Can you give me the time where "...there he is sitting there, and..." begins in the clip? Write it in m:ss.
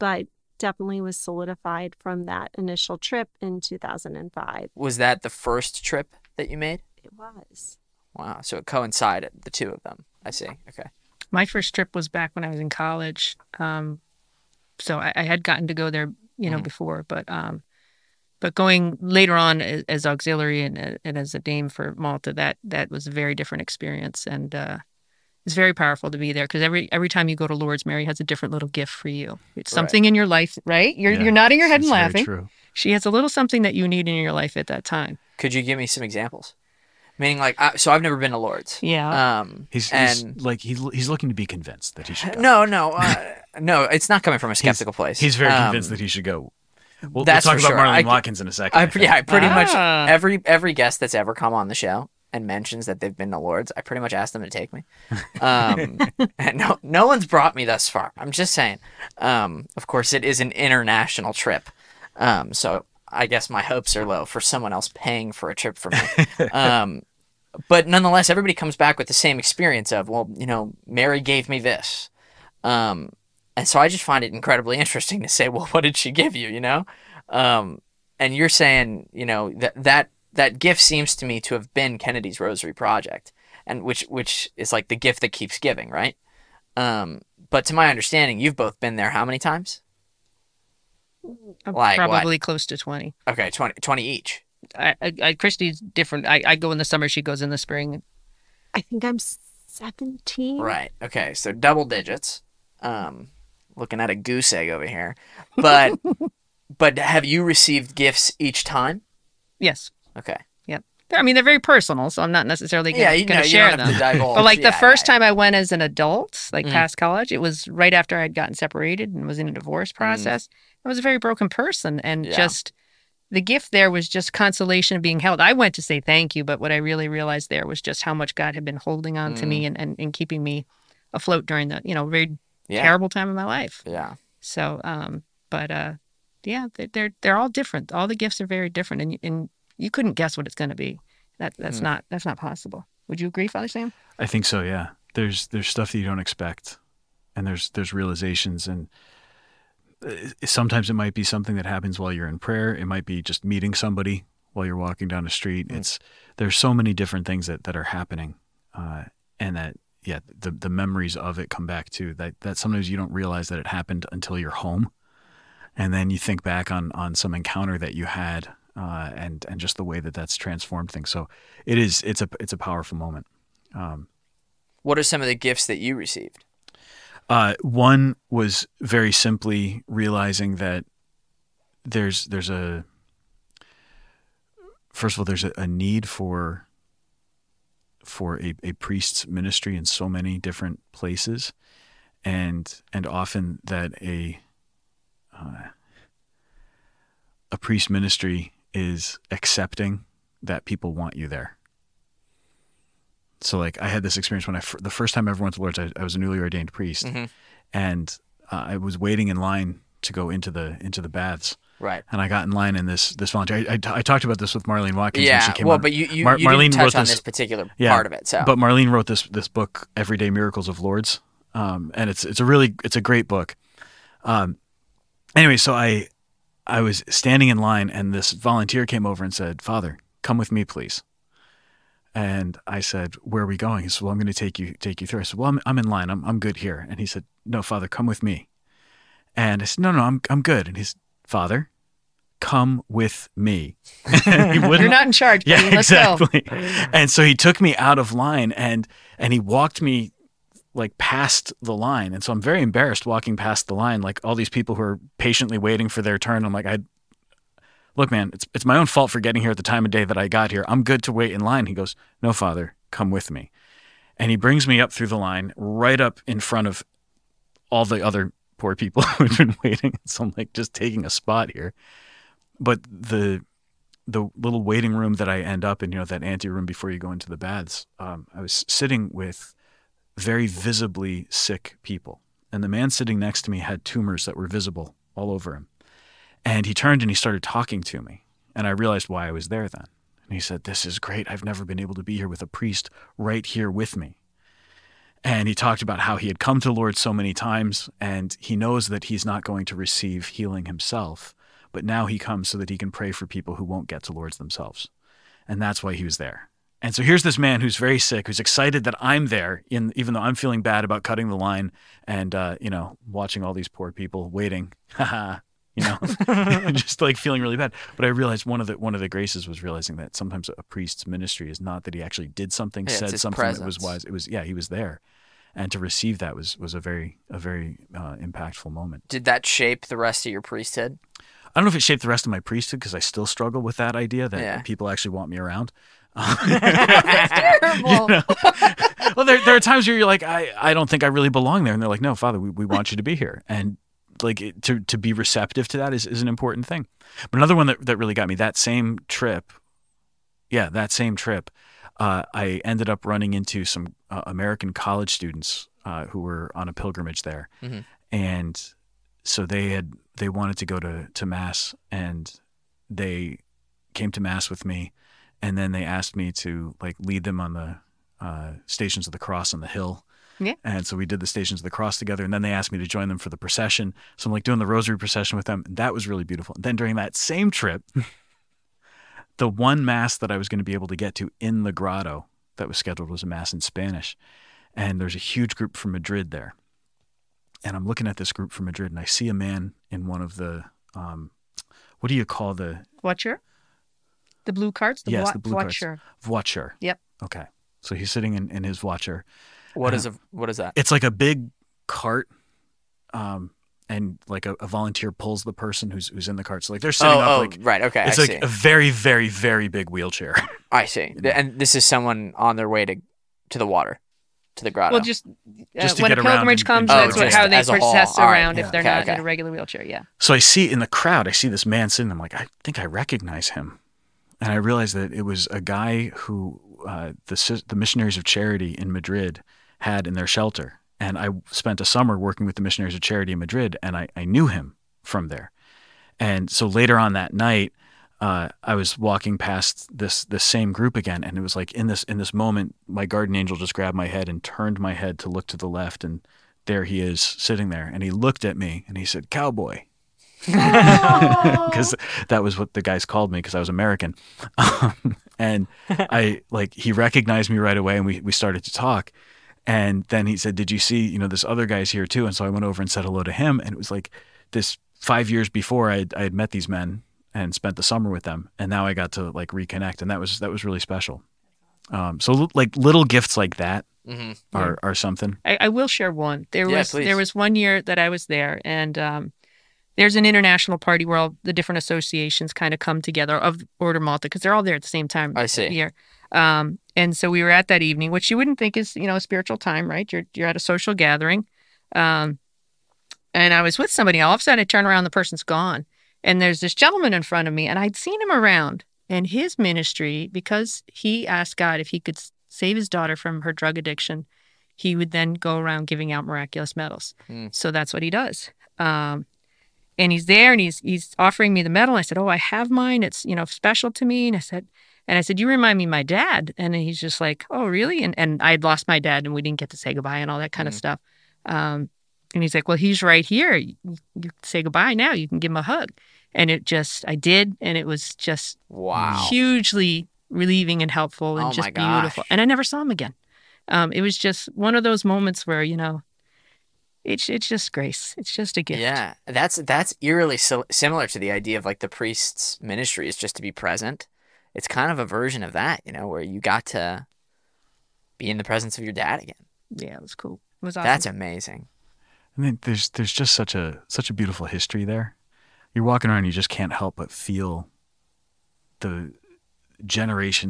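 7:26.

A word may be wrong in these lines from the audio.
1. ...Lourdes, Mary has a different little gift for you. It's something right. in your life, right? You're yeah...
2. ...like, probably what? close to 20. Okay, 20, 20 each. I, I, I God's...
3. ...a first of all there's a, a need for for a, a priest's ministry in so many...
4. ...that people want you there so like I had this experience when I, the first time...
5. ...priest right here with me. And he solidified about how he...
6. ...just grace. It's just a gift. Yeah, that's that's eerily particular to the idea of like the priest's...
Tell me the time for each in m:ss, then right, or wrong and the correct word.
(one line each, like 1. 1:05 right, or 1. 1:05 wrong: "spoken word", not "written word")
1. 0:27 right
2. 1:31 wrong: "Kristy", not "God"
3. 3:02 right
4. 3:20 right
5. 4:52 wrong: "talked", not "solidified"
6. 8:57 wrong: "similar", not "particular".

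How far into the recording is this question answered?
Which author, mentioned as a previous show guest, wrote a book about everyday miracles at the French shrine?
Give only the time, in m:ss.
3:34.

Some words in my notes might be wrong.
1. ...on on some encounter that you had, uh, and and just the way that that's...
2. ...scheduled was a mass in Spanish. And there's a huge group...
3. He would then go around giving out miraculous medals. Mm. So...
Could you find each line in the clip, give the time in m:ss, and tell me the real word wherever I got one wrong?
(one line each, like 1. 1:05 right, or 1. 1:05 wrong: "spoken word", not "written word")
1. 2:46 right
2. 6:22 right
3. 8:24 right.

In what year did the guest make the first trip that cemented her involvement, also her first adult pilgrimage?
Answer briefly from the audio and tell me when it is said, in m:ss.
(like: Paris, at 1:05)
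2005, at 0:03.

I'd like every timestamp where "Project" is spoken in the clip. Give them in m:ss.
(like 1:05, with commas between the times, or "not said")
1:22.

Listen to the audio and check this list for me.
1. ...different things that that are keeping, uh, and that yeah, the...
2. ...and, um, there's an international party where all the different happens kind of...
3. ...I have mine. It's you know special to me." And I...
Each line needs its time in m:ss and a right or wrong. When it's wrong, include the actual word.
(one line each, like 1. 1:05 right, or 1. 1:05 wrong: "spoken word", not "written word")
1. 2:36 wrong: "happening", not "keeping"
2. 7:58 wrong: "associations", not "happens"
3. 8:32 right.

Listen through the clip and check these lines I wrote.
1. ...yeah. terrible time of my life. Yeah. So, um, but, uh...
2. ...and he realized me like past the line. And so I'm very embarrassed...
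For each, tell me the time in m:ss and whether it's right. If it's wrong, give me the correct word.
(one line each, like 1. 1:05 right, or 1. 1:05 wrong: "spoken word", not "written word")
1. 2:12 right
2. 4:09 wrong: "walked", not "realized".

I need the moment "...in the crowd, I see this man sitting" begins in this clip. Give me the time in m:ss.
7:00.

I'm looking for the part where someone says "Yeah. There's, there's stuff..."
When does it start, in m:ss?
2:24.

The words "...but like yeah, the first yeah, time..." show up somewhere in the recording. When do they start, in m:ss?
1:53.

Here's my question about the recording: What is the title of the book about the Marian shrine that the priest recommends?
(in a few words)
Everyday Miracles of Lourdes.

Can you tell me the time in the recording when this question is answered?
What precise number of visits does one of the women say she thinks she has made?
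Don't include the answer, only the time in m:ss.
1:38.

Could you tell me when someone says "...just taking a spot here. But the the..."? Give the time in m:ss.
4:30.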